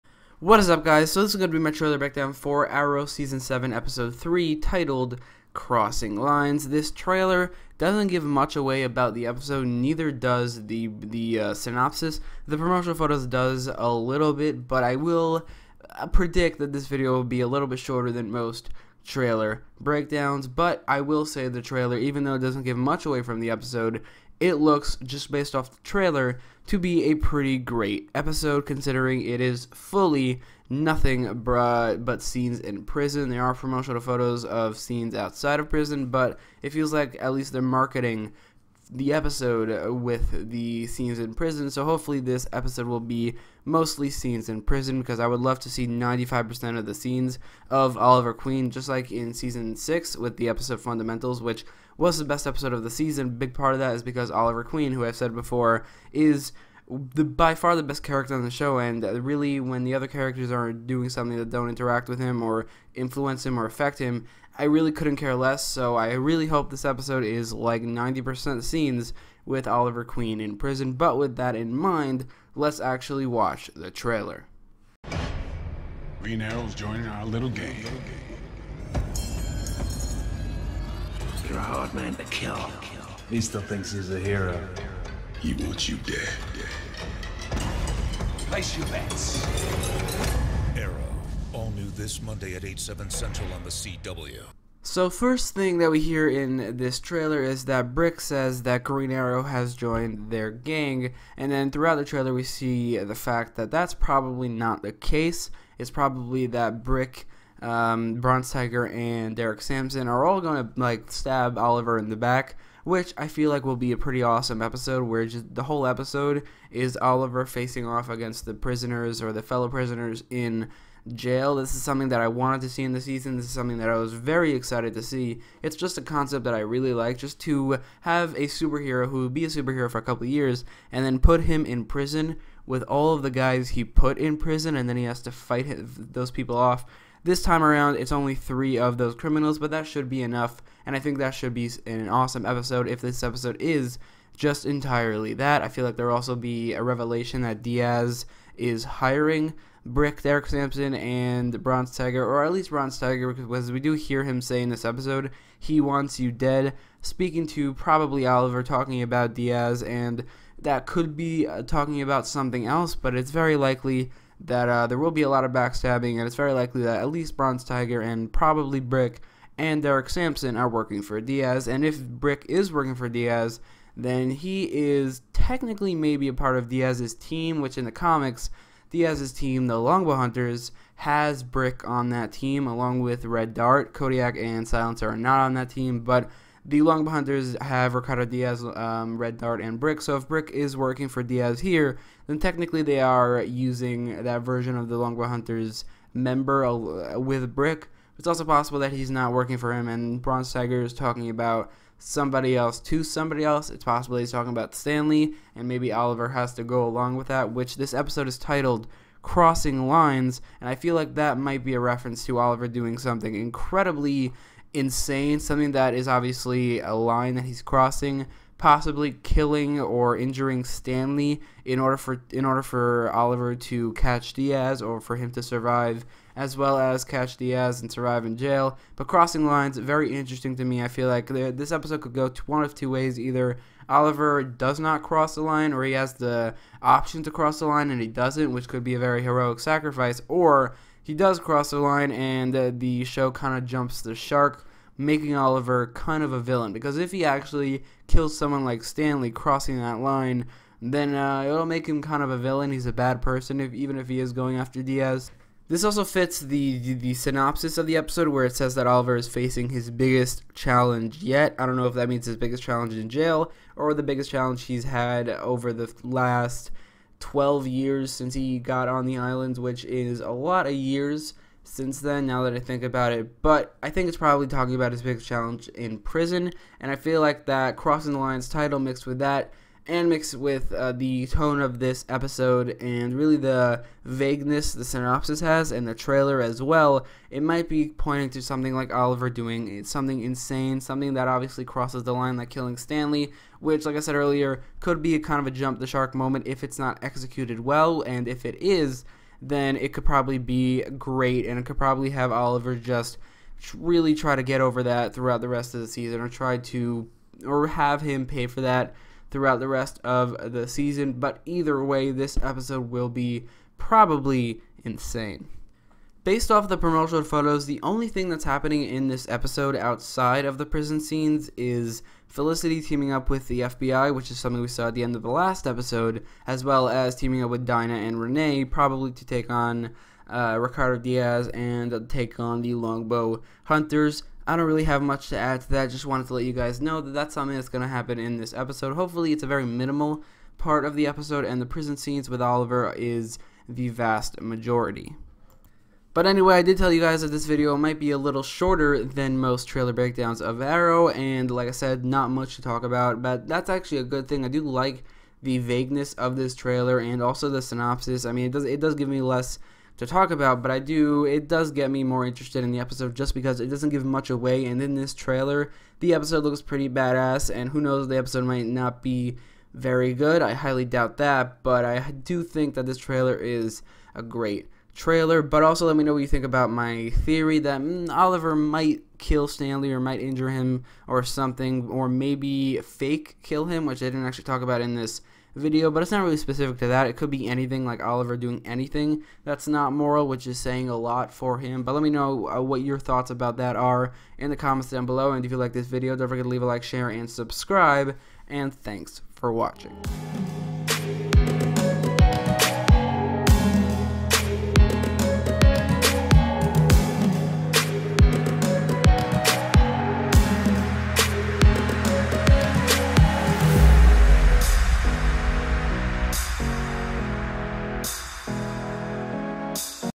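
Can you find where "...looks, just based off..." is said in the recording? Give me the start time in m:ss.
0:24.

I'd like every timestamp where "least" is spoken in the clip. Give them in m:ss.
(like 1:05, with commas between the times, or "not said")
0:37, 2:32, 2:47.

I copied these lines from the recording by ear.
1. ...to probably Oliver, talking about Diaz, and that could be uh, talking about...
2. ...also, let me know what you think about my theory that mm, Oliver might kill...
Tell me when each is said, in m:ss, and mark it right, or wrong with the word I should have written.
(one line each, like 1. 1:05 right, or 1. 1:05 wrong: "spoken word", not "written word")
1. 2:37 right
2. 6:15 right.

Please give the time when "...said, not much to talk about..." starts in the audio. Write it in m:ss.
5:51.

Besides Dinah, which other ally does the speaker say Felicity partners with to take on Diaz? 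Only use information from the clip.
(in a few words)
Renee.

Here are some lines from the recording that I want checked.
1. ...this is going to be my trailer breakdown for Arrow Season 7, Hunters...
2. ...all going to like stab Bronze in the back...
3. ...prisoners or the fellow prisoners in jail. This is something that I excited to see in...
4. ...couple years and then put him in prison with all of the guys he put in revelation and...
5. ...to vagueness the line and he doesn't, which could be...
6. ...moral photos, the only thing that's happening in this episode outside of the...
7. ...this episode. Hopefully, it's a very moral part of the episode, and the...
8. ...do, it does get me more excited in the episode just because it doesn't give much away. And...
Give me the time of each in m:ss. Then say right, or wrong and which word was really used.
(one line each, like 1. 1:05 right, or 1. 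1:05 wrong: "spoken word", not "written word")
1. 0:01 wrong: "Episode", not "Hunters"
2. 1:50 wrong: "Oliver", not "Bronze"
3. 1:58 wrong: "wanted", not "excited"
4. 2:10 wrong: "prison", not "revelation"
5. 3:57 wrong: "cross", not "vagueness"
6. 5:16 wrong: "promotional", not "moral"
7. 5:38 wrong: "minimal", not "moral"
8. 6:00 wrong: "interested", not "excited".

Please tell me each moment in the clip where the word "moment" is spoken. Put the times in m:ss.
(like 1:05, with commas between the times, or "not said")
4:56.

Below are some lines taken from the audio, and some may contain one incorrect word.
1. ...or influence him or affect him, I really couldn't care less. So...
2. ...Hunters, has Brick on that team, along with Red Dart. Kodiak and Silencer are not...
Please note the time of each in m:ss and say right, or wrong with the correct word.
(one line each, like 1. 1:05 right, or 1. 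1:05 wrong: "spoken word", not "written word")
1. 1:02 right
2. 3:00 right.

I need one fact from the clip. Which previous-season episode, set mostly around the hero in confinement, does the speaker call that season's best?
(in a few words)
Fundamentals.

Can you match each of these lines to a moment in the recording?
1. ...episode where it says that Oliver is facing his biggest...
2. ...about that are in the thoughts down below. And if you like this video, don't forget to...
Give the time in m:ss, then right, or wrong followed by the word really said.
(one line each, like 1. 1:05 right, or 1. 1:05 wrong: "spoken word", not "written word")
1. 4:17 right
2. 6:33 wrong: "comments", not "thoughts".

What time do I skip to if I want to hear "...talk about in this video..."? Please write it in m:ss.
6:24.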